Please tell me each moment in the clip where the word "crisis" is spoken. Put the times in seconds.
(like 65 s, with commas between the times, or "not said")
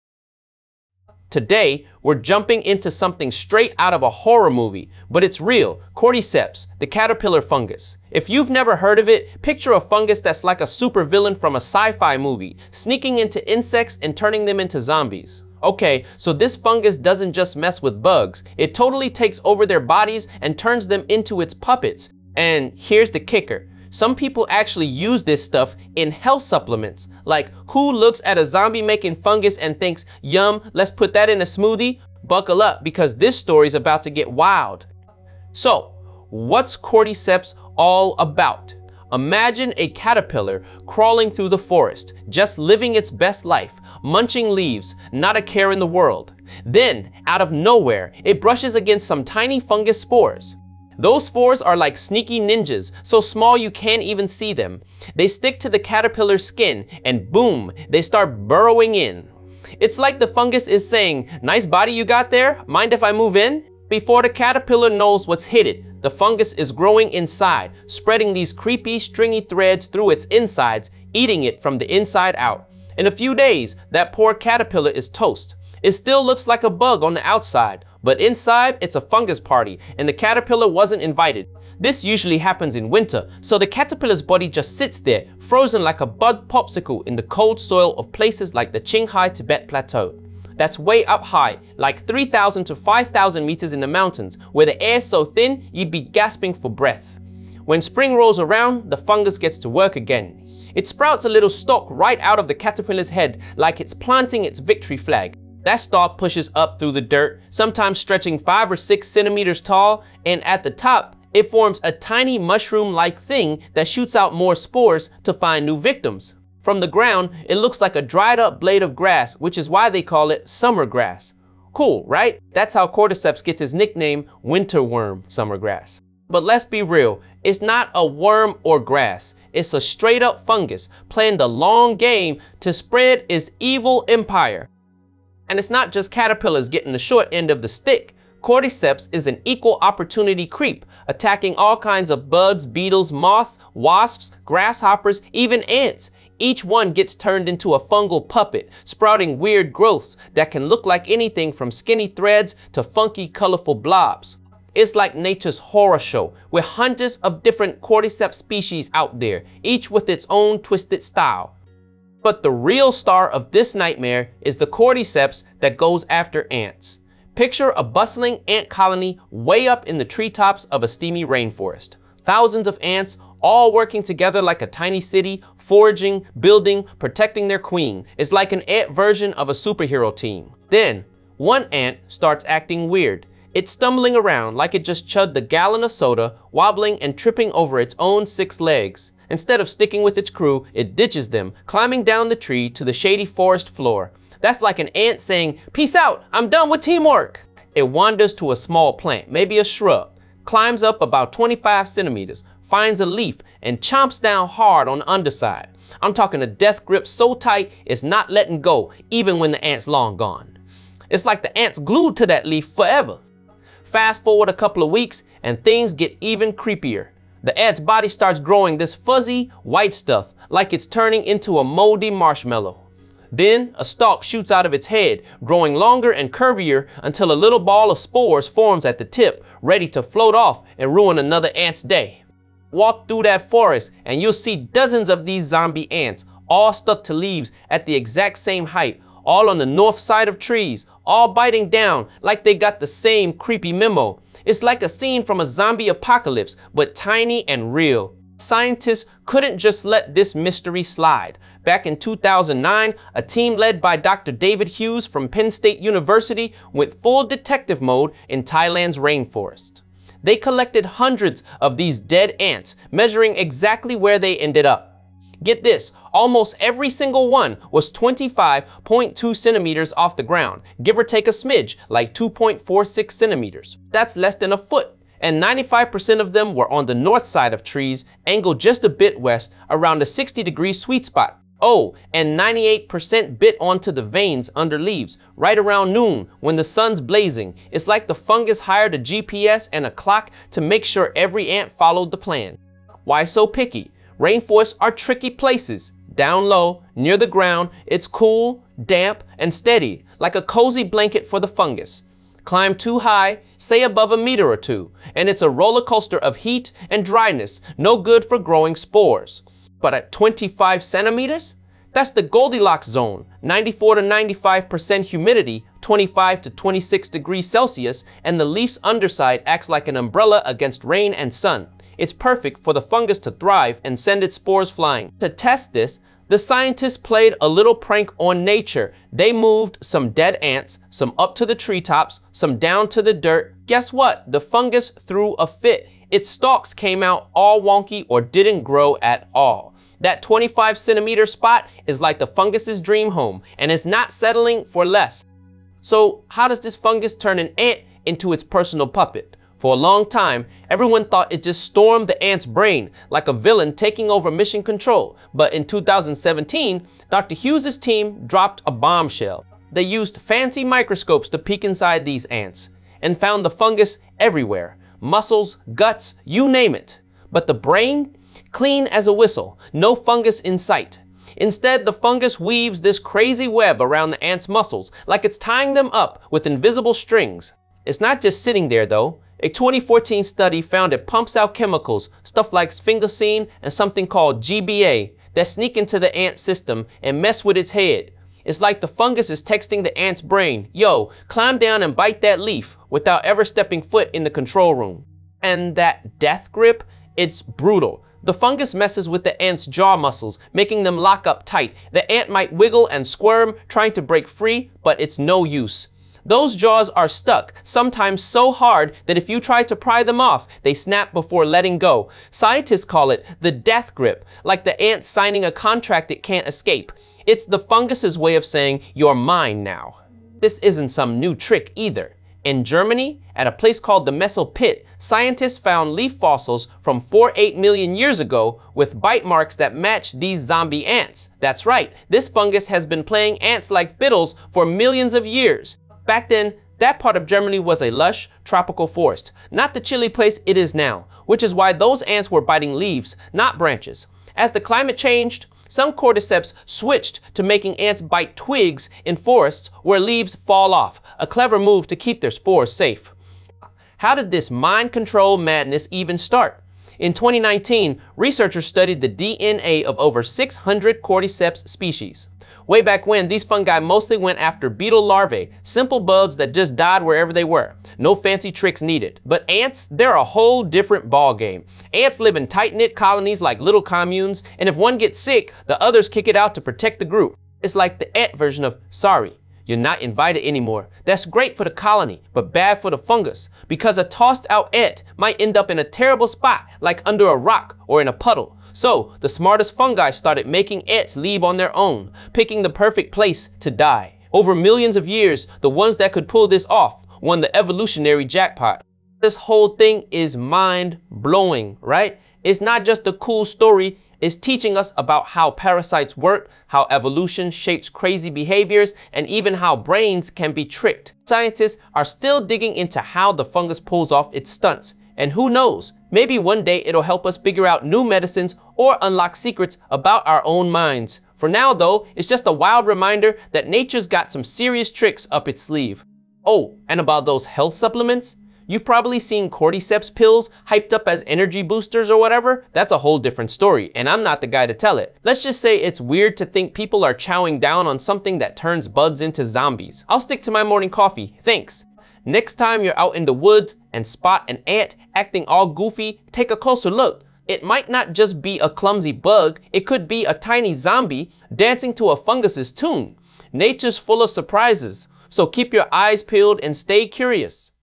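not said.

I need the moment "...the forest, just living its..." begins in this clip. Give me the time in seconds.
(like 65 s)
41 s.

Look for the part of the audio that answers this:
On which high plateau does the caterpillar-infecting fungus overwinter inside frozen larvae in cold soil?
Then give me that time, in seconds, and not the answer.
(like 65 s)
88 s.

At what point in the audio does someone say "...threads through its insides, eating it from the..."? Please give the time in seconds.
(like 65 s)
69 s.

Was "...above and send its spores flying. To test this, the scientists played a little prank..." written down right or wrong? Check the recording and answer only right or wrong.
wrong.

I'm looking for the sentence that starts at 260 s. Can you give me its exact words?
They collected hundreds of these dead ants, measuring exactly where they ended up.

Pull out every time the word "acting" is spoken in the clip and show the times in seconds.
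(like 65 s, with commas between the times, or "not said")
182 s, 545 s.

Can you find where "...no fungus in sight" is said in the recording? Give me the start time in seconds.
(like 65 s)
369 s.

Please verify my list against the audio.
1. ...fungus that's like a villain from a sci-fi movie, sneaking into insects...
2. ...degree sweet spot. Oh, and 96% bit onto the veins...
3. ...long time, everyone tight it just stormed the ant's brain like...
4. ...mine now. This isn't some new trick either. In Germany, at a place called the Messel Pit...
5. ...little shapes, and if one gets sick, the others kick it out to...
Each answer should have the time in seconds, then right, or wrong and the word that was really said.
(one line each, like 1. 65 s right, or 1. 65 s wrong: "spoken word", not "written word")
1. 9 s wrong: "supervillain", not "villain"
2. 280 s wrong: "98", not "96"
3. 349 s wrong: "thought", not "tight"
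4. 419 s right
5. 473 s wrong: "communes", not "shapes".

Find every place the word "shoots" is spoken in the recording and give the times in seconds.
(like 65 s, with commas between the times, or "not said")
113 s, 224 s.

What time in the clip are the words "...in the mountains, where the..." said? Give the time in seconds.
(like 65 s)
93 s.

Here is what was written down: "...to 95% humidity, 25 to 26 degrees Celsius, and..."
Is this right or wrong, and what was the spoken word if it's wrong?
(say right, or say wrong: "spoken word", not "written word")
right.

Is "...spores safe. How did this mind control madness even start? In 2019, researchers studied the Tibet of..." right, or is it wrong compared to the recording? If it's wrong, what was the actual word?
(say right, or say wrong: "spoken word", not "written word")
wrong: "DNA", not "Tibet".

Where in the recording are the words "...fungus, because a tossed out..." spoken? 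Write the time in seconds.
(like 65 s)
482 s.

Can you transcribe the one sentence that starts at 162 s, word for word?
But the real star of this nightmare is the cordyceps that goes after ants.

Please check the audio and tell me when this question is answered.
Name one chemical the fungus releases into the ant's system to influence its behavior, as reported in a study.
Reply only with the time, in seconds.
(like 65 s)
382 s.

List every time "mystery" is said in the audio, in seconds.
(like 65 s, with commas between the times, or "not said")
250 s.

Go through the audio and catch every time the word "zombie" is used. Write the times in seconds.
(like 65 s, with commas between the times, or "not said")
14 s, 28 s, 235 s, 245 s, 430 s, 539 s, 550 s.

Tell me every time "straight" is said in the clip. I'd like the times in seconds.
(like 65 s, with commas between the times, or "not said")
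3 s, 129 s.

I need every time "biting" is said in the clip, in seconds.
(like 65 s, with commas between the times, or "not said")
241 s, 442 s.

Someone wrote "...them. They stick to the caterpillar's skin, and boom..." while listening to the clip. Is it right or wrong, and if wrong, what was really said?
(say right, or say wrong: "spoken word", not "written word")
right.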